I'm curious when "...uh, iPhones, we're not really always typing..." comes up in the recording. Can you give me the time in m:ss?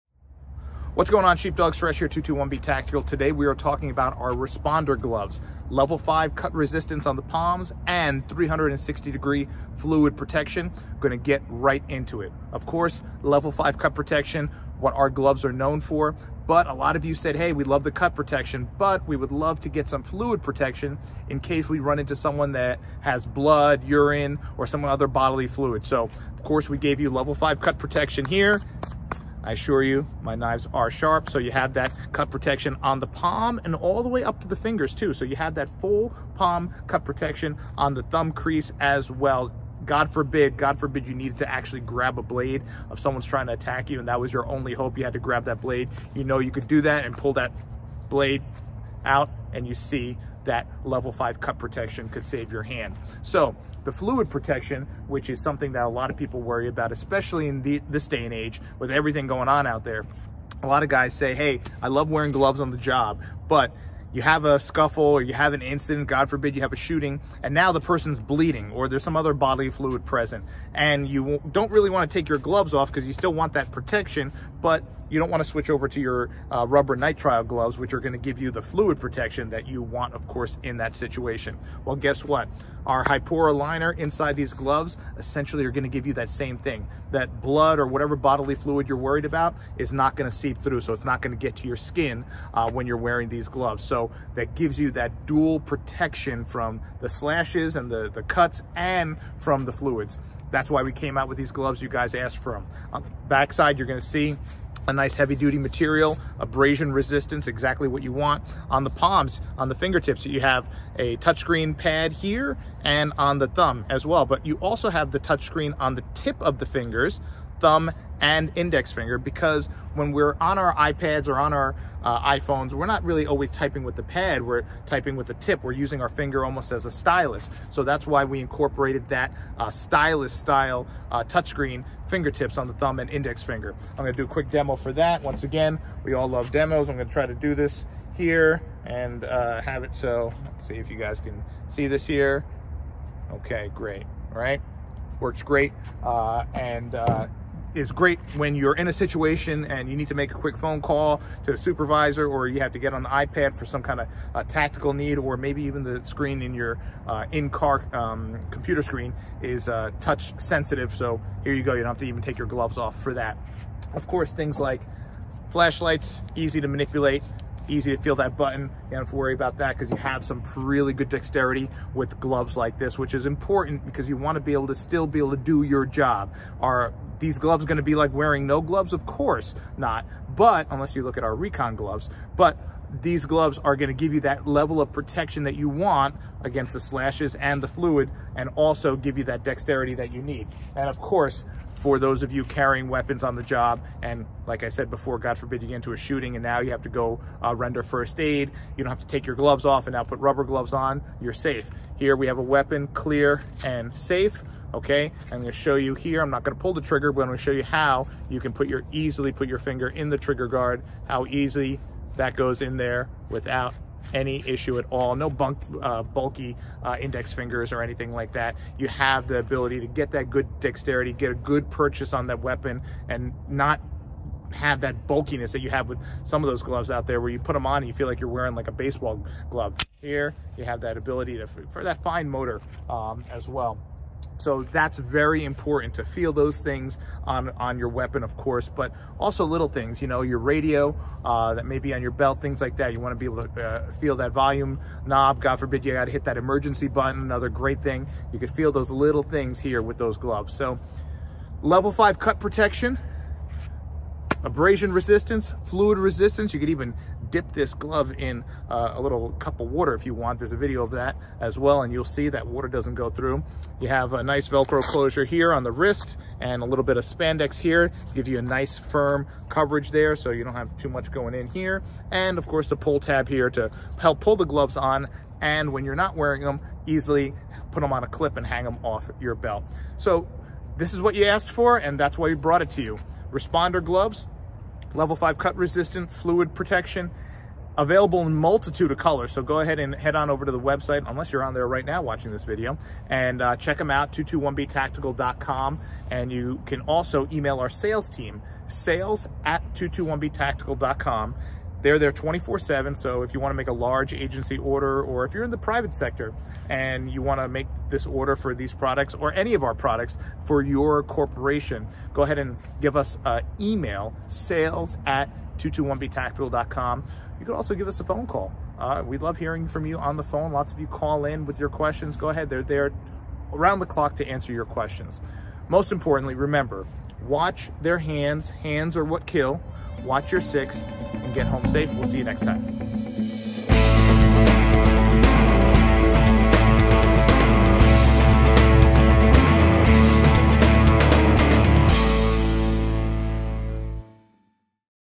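2:02.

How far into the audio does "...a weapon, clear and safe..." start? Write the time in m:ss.
3:22.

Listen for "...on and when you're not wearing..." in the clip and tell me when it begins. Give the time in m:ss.
4:34.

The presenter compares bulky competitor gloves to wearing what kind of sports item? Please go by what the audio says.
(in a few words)
a baseball glove.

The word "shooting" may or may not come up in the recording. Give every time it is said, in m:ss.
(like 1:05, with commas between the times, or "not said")
1:06, 3:15.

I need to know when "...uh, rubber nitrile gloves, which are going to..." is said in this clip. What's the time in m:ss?
1:16.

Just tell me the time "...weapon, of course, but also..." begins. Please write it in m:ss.
3:57.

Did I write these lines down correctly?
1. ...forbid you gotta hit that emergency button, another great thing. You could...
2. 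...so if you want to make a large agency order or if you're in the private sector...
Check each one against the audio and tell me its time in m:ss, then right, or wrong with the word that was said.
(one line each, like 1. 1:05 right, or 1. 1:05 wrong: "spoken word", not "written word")
1. 4:05 right
2. 5:02 right.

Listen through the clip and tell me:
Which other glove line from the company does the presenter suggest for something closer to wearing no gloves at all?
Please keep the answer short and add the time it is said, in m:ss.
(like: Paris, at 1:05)
Recon, at 3:01.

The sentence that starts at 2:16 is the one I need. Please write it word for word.
I'm gonna try to do this here and uh, have it so, let's see if you guys can see this here.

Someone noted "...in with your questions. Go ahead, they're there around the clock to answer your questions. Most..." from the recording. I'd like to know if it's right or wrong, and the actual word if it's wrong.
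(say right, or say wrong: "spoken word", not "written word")
right.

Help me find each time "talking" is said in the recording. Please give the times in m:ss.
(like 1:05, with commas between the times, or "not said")
0:03.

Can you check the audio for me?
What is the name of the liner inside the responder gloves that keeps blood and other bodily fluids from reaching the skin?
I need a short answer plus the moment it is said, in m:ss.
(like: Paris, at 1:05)
Hipora, at 1:23.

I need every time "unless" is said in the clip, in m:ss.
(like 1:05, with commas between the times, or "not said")
3:00, 4:51.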